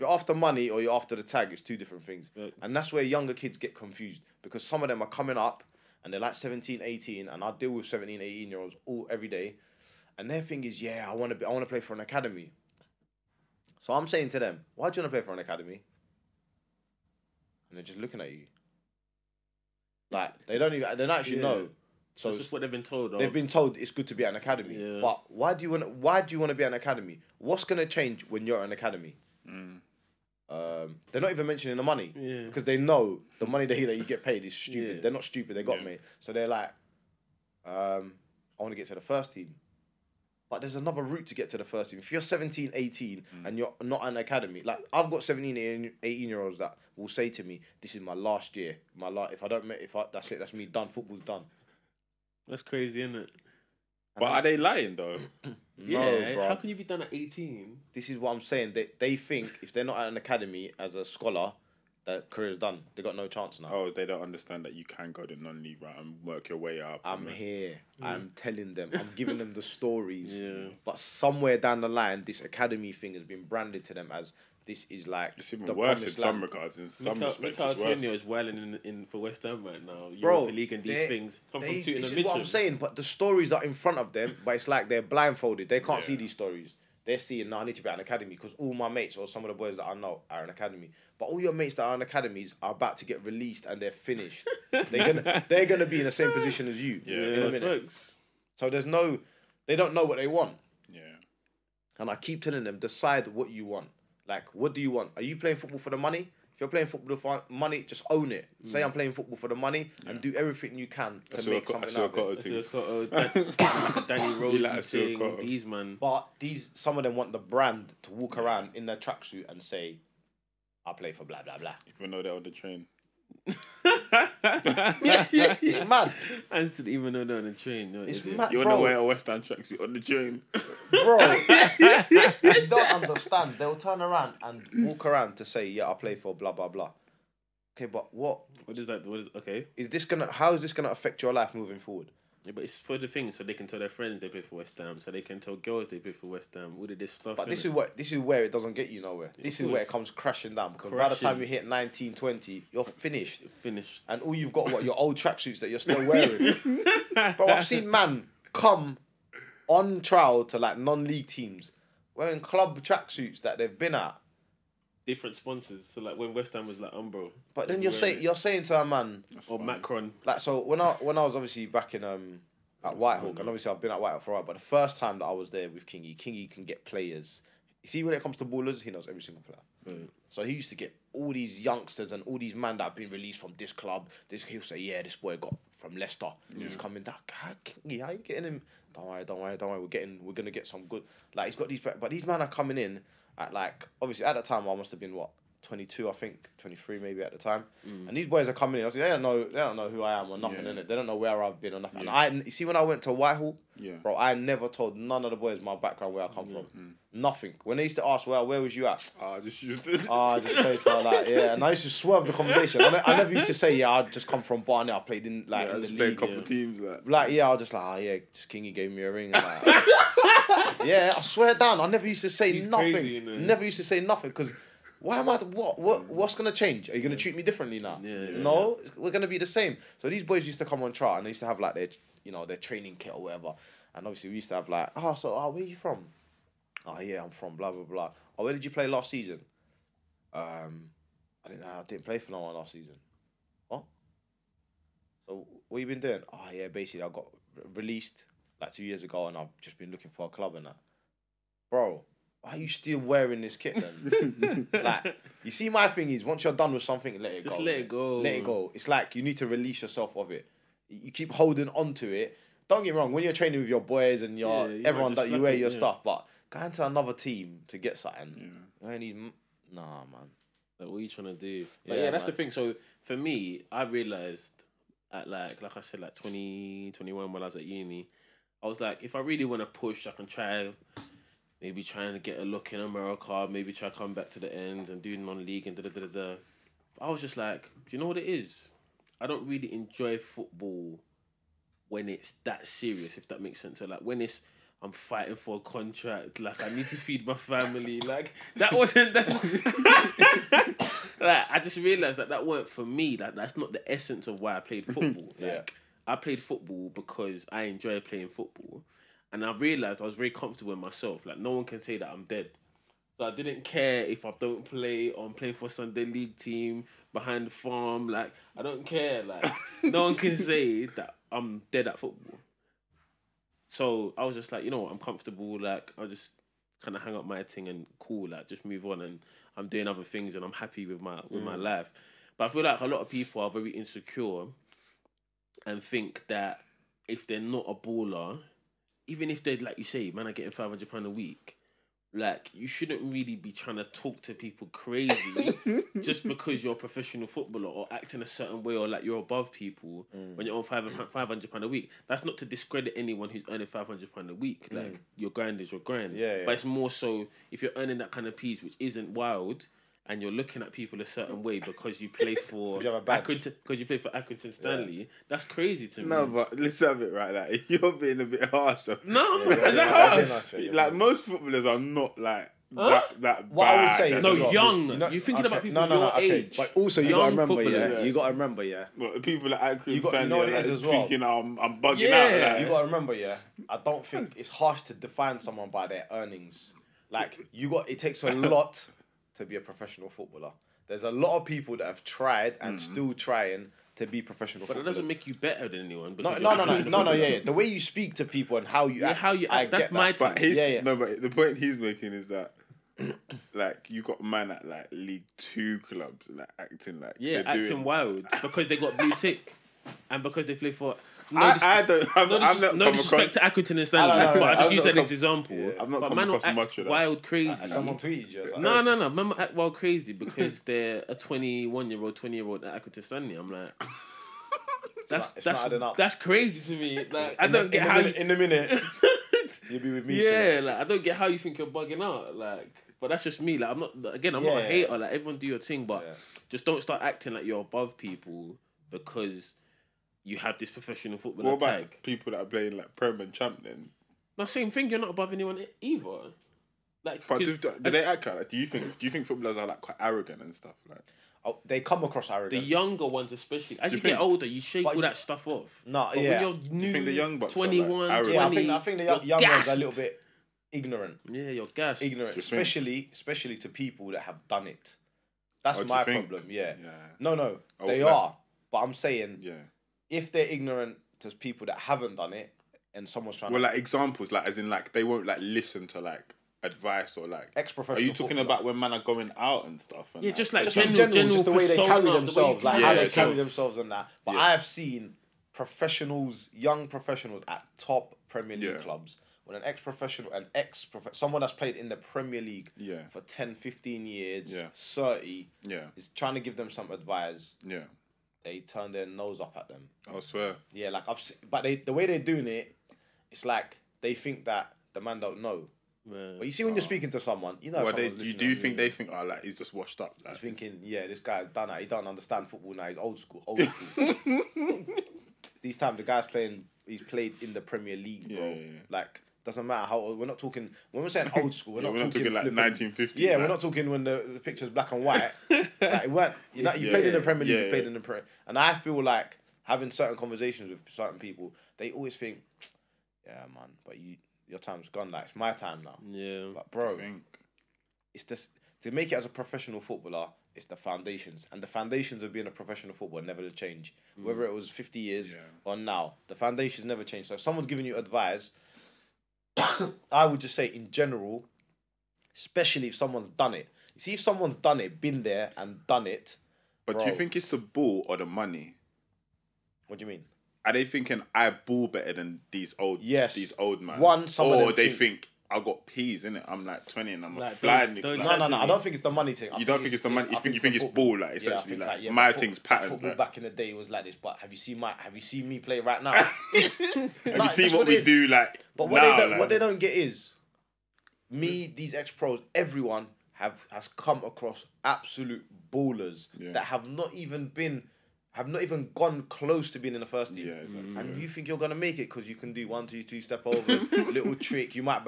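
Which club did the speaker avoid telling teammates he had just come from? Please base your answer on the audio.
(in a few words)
Barnet.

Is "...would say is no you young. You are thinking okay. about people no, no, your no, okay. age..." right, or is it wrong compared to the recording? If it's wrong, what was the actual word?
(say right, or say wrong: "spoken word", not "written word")
right.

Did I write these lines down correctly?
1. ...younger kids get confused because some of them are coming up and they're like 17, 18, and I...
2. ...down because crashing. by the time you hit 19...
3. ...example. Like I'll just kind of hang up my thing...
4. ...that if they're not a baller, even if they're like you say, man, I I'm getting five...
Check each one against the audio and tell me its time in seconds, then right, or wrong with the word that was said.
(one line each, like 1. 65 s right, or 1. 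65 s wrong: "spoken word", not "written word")
1. 3 s right
2. 150 s right
3. 324 s wrong: "comfortable", not "example"
4. 336 s right.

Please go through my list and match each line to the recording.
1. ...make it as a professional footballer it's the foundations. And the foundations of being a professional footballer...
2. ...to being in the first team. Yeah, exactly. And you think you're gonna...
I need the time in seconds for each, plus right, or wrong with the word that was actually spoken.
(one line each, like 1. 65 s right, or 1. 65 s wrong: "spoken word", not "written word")
1. 538 s right
2. 589 s right.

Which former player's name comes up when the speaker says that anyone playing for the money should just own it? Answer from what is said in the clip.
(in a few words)
Danny Rose.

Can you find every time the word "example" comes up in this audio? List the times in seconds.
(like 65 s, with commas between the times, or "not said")
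415 s, 473 s.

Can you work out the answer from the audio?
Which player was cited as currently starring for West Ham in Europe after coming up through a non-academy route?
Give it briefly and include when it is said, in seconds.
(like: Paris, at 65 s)
Antonio, at 77 s.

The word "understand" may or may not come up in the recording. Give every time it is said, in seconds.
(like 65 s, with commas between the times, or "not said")
64 s, 133 s, 512 s.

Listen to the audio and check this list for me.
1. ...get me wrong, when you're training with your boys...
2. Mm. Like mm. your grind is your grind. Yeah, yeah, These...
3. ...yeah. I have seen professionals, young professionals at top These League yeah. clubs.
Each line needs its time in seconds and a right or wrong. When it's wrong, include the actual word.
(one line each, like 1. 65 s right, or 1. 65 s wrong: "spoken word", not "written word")
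1. 262 s right
2. 354 s wrong: "But", not "These"
3. 484 s wrong: "Premier", not "These".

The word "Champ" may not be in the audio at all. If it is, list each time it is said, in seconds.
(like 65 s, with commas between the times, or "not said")
443 s.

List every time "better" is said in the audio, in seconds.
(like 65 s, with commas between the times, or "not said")
395 s, 561 s.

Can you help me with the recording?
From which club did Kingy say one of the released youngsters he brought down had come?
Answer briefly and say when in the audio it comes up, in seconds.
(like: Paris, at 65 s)
Leicester, at 185 s.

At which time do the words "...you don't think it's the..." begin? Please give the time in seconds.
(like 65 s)
569 s.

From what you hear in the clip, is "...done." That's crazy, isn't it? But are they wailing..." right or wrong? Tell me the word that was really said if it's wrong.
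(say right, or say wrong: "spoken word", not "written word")
wrong: "lying", not "wailing".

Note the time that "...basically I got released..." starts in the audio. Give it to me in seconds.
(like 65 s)
246 s.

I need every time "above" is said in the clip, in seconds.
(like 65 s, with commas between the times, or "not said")
349 s, 437 s, 445 s.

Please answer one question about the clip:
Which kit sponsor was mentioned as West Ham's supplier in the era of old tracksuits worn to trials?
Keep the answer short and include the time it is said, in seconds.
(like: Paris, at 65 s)
Umbro, at 166 s.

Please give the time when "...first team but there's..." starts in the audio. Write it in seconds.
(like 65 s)
38 s.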